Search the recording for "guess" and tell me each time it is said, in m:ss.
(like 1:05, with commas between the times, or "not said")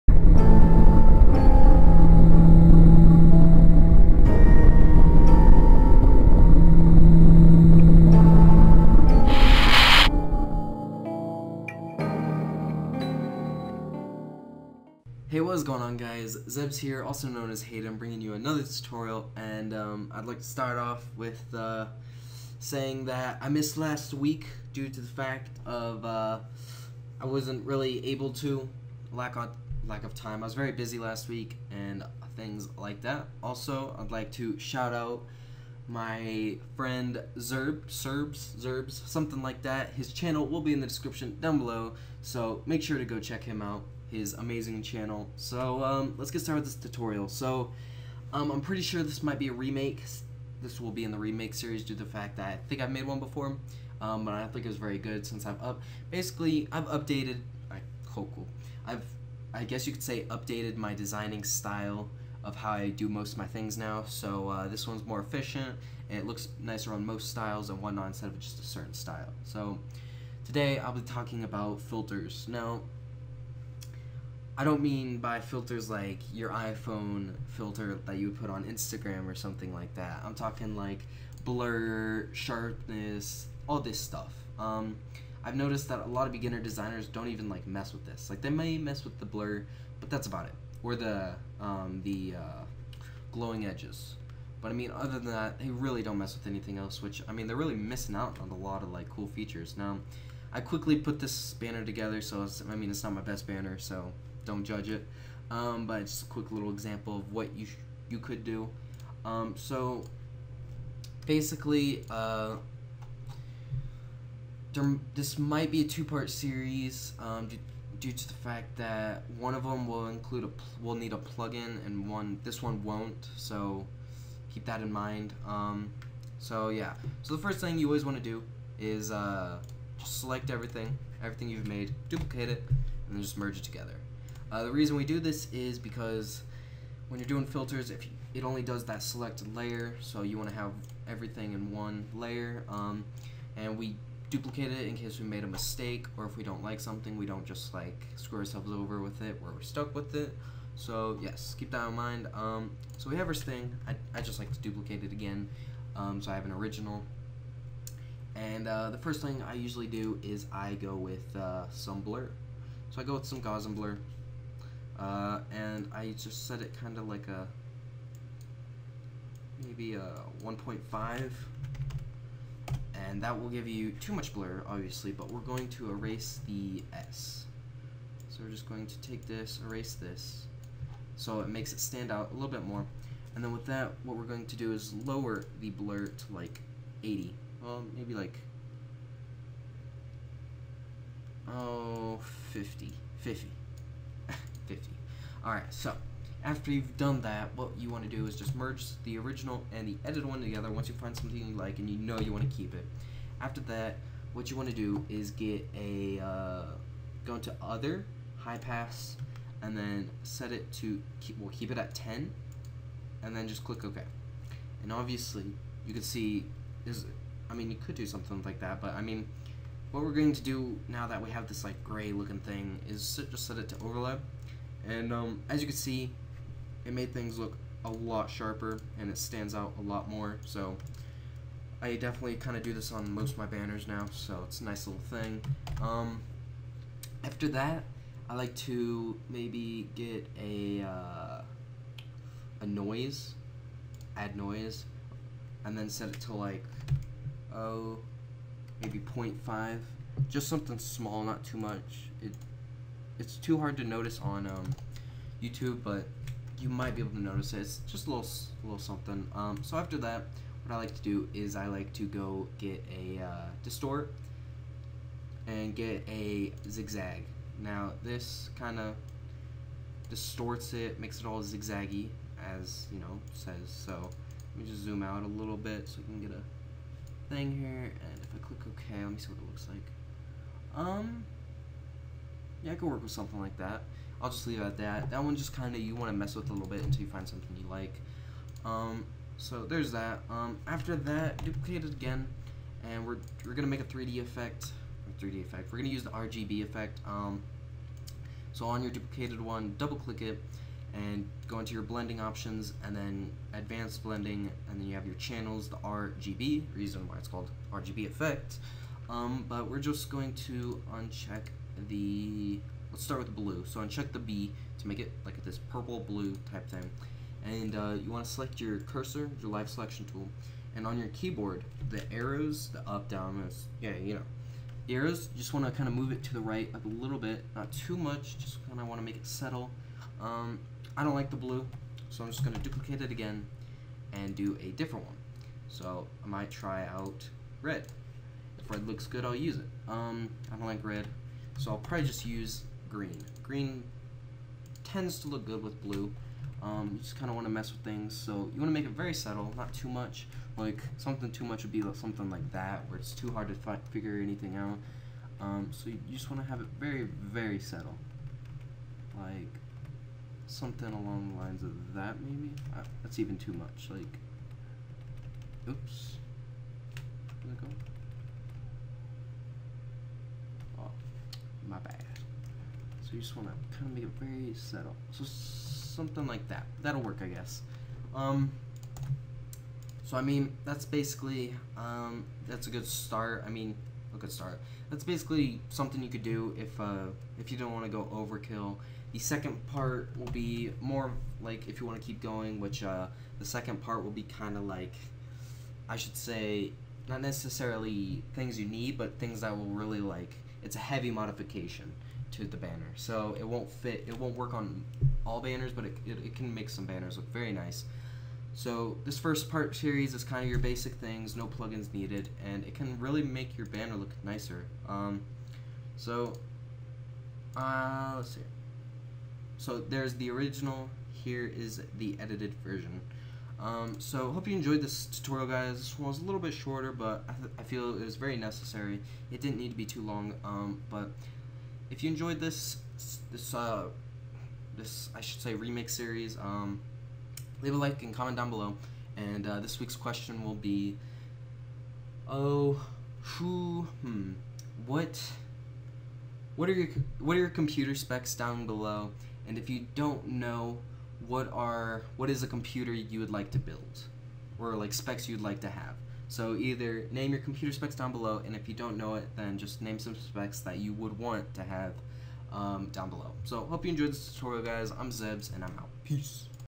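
0:59, 6:17.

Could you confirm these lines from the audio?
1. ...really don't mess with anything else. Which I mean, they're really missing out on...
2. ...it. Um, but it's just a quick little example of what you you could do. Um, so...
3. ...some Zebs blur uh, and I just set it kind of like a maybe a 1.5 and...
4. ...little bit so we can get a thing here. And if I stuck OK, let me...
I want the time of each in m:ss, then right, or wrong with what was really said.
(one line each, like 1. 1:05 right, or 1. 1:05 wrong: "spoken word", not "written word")
1. 1:35 right
2. 1:44 right
3. 2:43 wrong: "Gaussian", not "Zebs"
4. 4:35 wrong: "click", not "stuck".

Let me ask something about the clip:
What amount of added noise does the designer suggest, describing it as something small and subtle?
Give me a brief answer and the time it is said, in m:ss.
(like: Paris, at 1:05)
0.5, at 4:08.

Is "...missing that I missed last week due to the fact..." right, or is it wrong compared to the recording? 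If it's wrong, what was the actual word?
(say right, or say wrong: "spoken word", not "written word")
wrong: "saying", not "missing".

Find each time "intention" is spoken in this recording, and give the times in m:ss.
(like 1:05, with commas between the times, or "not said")
not said.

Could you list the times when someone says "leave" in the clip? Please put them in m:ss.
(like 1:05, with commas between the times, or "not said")
4:44, 7:17.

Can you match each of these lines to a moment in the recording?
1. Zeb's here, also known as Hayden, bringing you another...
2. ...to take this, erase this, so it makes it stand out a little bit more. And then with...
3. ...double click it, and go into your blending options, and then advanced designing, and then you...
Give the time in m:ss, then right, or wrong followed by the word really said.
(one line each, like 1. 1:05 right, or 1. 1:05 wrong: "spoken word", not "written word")
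1. 0:16 right
2. 2:58 right
3. 4:59 wrong: "blending", not "designing".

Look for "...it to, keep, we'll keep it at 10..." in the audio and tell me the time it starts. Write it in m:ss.
3:30.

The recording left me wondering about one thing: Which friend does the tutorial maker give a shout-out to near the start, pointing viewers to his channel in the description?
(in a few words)
Zerb.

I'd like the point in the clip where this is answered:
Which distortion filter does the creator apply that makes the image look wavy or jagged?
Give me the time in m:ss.
4:26.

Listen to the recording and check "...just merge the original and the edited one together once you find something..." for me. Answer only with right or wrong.
right.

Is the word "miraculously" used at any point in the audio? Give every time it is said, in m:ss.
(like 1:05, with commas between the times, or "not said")
not said.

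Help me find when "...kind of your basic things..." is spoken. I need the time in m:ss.
6:50.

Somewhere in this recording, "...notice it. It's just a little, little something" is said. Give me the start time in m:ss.
4:17.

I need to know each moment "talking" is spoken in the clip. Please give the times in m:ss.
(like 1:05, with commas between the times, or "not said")
1:11, 1:20.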